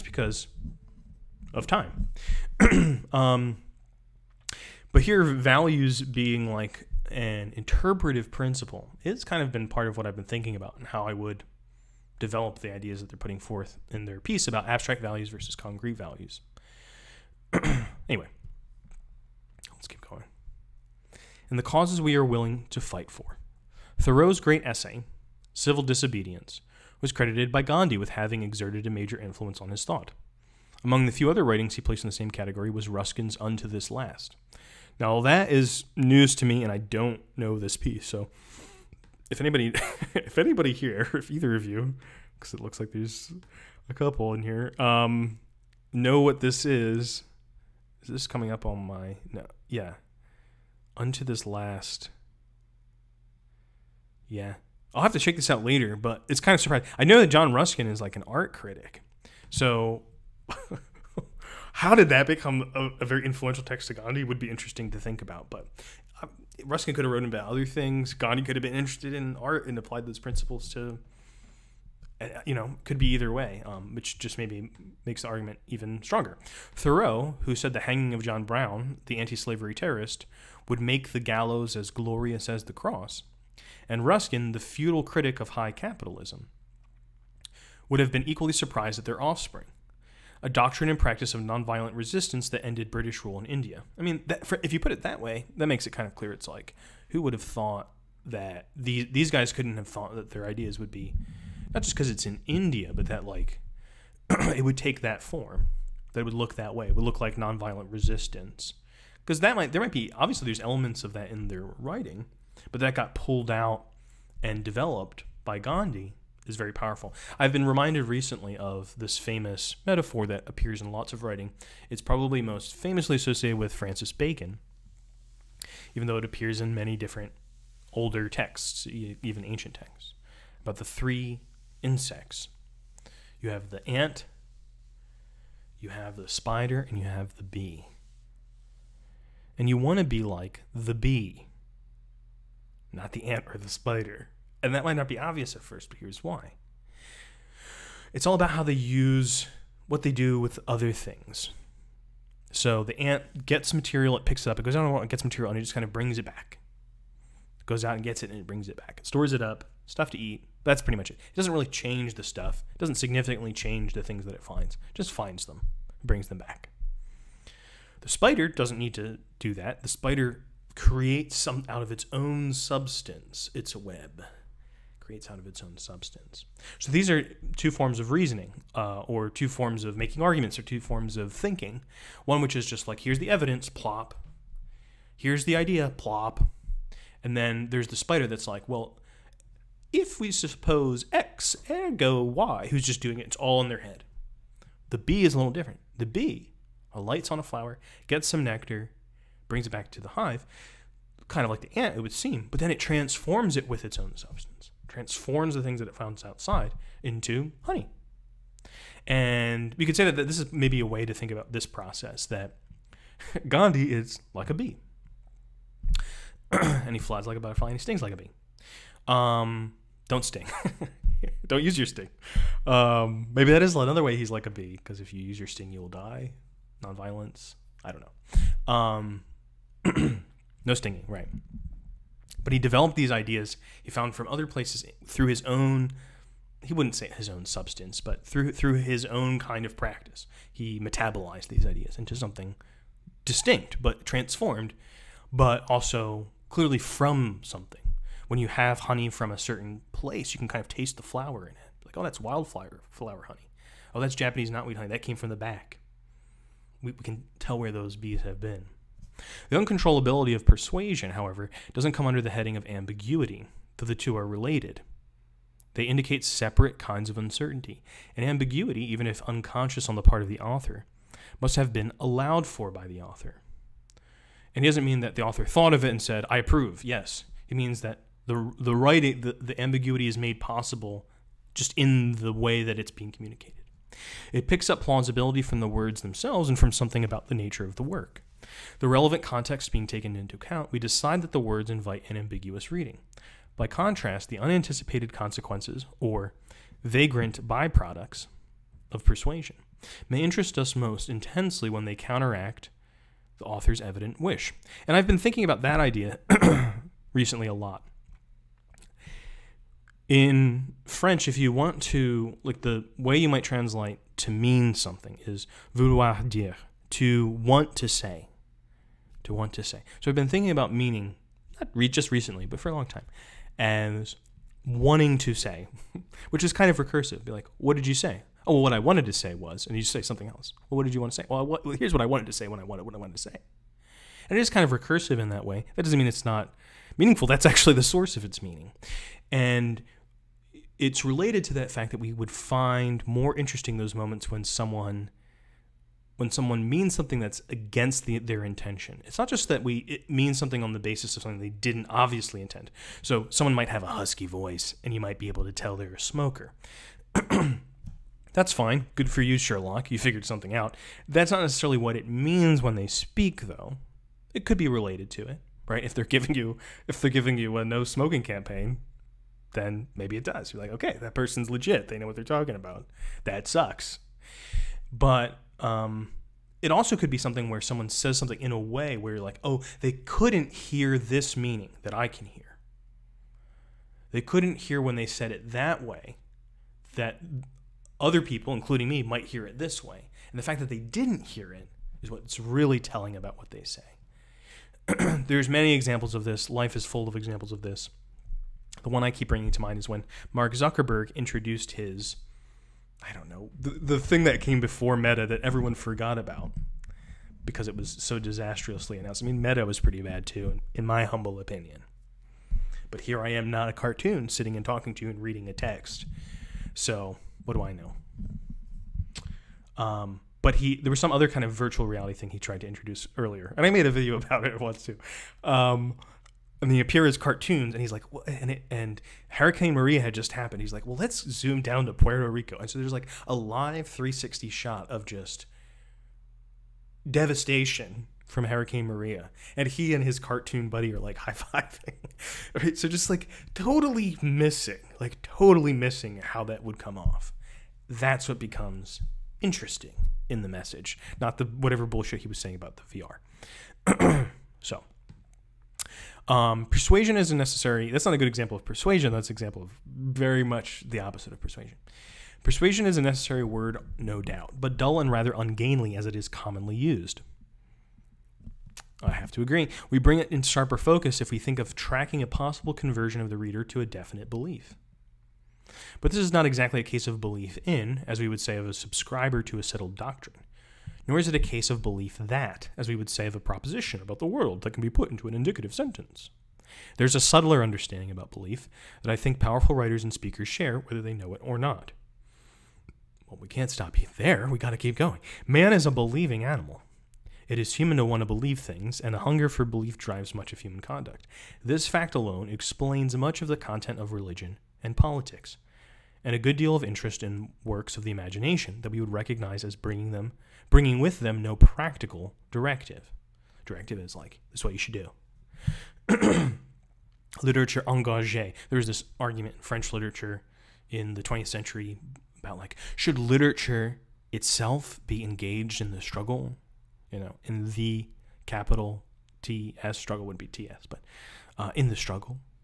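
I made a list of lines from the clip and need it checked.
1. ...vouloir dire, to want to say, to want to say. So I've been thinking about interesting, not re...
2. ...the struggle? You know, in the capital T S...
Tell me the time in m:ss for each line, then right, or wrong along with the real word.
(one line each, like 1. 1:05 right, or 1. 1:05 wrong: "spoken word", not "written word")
1. 5:15 wrong: "meaning", not "interesting"
2. 8:45 right.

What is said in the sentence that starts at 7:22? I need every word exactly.
So just like totally missing, like totally missing how that would come off.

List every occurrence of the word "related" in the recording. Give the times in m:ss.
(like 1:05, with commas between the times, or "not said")
4:24, 5:41, 6:04.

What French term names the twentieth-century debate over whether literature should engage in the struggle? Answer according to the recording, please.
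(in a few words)
literature engagé.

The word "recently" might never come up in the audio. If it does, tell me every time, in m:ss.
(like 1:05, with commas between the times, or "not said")
1:58, 5:07, 5:22.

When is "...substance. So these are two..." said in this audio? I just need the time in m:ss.
2:55.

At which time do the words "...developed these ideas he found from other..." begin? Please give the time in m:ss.
3:52.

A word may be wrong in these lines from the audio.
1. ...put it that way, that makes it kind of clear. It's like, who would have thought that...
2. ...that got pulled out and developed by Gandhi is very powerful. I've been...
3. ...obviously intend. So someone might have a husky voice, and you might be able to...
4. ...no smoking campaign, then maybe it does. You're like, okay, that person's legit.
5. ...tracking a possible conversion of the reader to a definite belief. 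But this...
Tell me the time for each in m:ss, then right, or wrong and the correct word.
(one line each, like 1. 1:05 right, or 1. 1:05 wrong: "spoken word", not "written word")
1. 1:34 right
2. 1:52 right
3. 5:51 right
4. 6:07 right
5. 7:51 right.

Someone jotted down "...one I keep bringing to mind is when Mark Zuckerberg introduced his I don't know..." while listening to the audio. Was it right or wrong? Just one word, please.
right.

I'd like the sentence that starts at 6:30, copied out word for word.
And the fact that they didn't hear it is what's really telling about what they say.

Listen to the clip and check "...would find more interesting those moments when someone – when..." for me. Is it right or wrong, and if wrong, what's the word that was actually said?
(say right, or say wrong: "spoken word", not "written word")
right.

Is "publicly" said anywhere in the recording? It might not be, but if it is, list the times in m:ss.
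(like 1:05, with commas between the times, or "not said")
not said.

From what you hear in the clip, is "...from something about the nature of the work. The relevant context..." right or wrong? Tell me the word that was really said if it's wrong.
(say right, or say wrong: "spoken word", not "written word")
right.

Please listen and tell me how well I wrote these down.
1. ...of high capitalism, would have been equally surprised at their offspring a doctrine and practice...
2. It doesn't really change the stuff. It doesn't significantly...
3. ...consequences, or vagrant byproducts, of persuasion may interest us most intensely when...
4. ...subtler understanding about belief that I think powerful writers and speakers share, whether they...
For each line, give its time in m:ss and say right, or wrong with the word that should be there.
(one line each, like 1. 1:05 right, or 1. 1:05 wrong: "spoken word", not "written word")
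1. 1:25 right
2. 2:41 right
3. 4:55 right
4. 8:07 right.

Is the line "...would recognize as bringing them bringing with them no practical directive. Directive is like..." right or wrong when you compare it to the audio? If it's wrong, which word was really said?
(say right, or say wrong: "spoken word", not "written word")
right.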